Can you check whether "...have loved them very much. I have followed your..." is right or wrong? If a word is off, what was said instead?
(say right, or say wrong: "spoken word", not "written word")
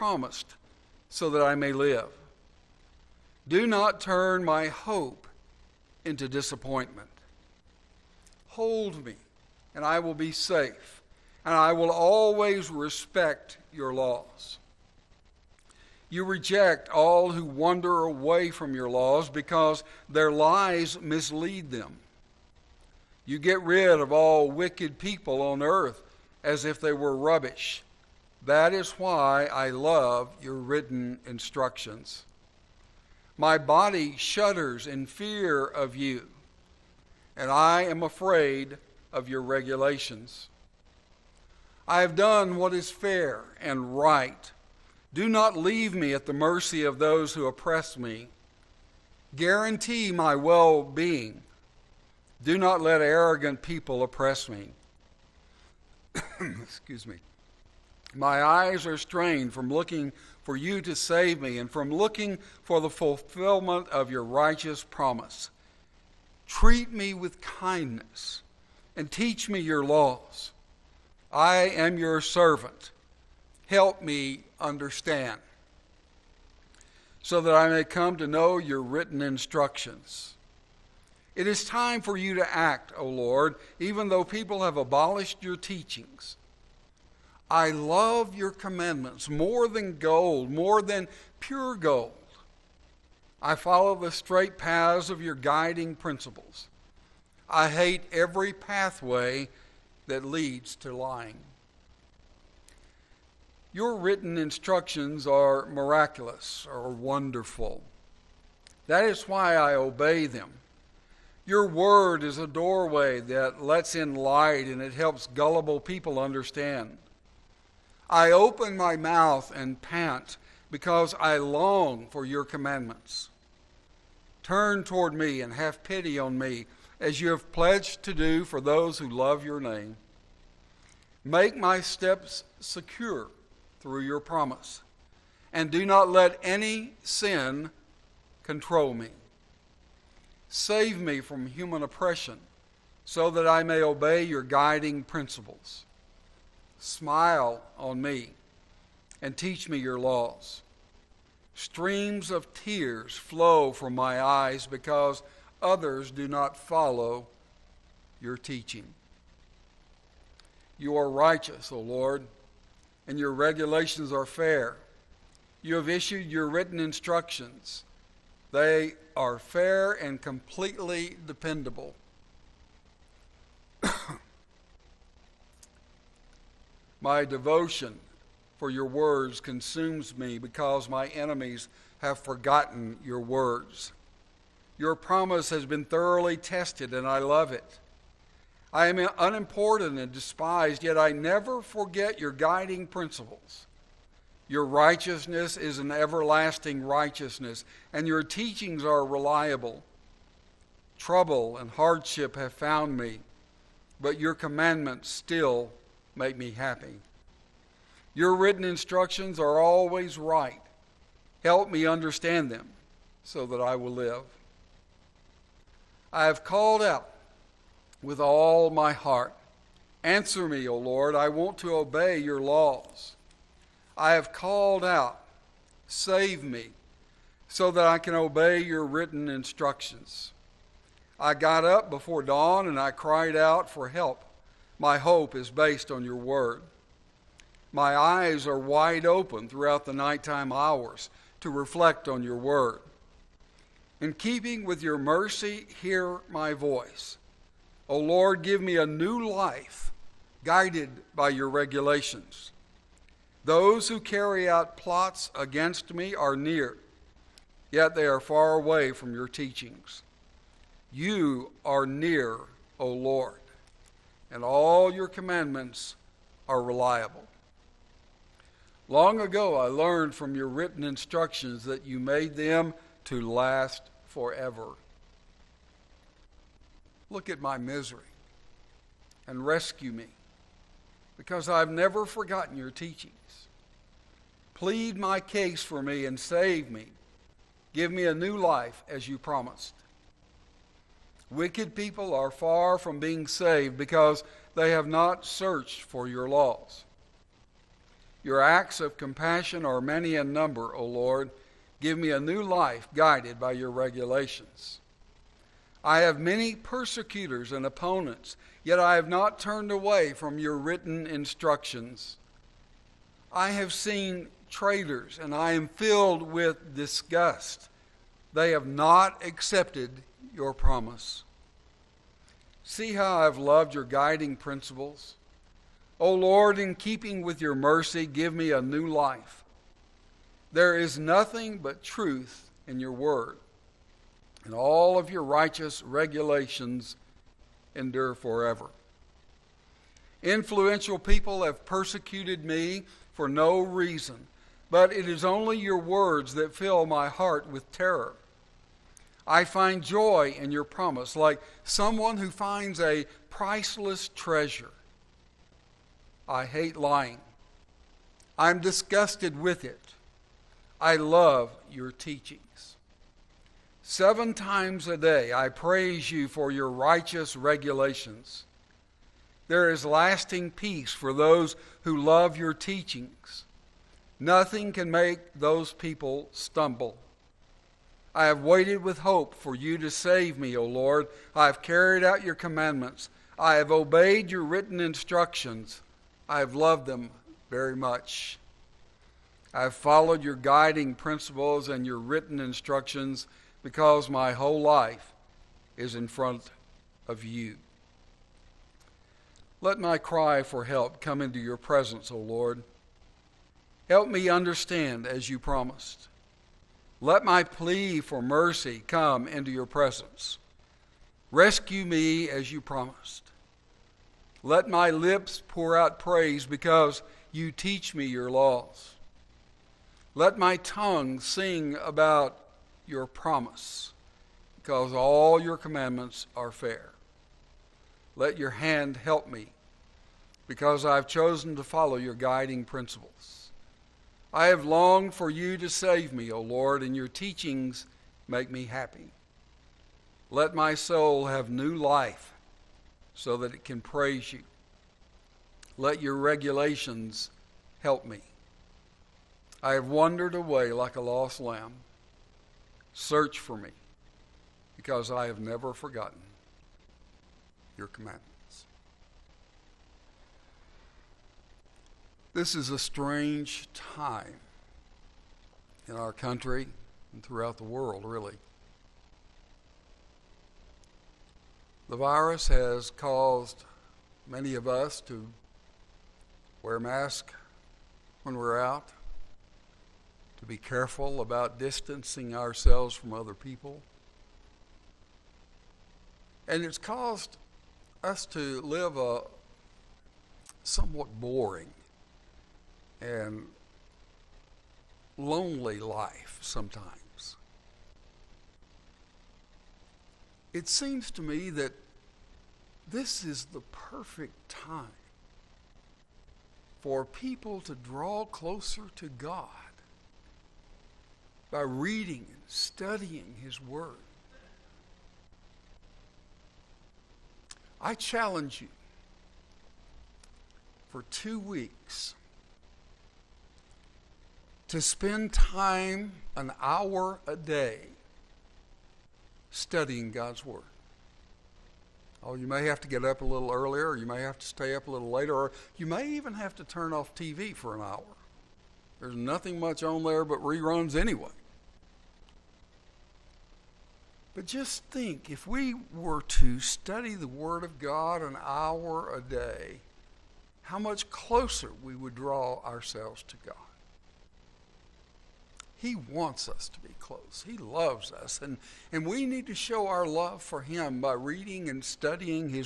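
right.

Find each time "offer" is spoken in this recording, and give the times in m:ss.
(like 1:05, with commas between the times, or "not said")
not said.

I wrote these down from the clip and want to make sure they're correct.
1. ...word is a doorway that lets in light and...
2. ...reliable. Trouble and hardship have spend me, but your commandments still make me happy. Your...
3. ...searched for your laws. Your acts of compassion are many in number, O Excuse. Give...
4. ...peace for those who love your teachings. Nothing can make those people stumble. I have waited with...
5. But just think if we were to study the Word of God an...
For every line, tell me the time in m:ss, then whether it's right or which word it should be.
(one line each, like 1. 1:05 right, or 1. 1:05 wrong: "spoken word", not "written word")
1. 1:51 right
2. 3:19 wrong: "found", not "spend"
3. 4:55 wrong: "Lord", not "Excuse"
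4. 6:10 right
5. 9:04 right.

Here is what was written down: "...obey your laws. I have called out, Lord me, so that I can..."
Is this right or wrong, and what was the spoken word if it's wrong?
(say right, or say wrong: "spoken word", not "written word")
wrong: "Save", not "Lord".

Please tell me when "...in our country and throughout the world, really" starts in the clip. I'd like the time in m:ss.
7:45.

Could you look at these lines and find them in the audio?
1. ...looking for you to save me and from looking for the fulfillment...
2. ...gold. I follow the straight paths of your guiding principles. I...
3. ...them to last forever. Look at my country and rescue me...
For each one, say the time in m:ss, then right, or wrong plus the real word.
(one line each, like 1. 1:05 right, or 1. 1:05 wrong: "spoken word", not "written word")
1. 0:59 right
2. 1:31 right
3. 4:32 wrong: "misery", not "country".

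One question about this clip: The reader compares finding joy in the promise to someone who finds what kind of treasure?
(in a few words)
a priceless treasure.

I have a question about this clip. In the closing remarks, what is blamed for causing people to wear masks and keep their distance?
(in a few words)
the virus.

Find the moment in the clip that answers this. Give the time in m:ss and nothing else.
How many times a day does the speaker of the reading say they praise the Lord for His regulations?
6:03.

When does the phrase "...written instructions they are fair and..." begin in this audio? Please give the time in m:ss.
2:46.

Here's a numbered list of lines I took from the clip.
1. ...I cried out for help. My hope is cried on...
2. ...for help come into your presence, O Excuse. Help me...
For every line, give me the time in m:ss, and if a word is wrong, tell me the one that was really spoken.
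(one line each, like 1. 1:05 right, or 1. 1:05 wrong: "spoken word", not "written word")
1. 3:52 wrong: "based", not "cried"
2. 6:40 wrong: "Lord", not "Excuse".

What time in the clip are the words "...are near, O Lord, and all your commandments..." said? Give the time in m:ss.
4:21.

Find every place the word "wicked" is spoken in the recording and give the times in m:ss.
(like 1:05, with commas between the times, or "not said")
0:24, 4:51.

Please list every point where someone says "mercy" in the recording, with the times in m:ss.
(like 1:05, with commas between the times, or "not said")
0:46, 4:04, 5:27, 6:48.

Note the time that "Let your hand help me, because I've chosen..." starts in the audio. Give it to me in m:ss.
7:08.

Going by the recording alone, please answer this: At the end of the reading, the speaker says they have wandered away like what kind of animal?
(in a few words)
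a lost lamb.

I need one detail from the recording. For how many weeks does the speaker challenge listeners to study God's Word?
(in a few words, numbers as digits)
2.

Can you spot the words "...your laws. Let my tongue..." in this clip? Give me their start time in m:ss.
6:58.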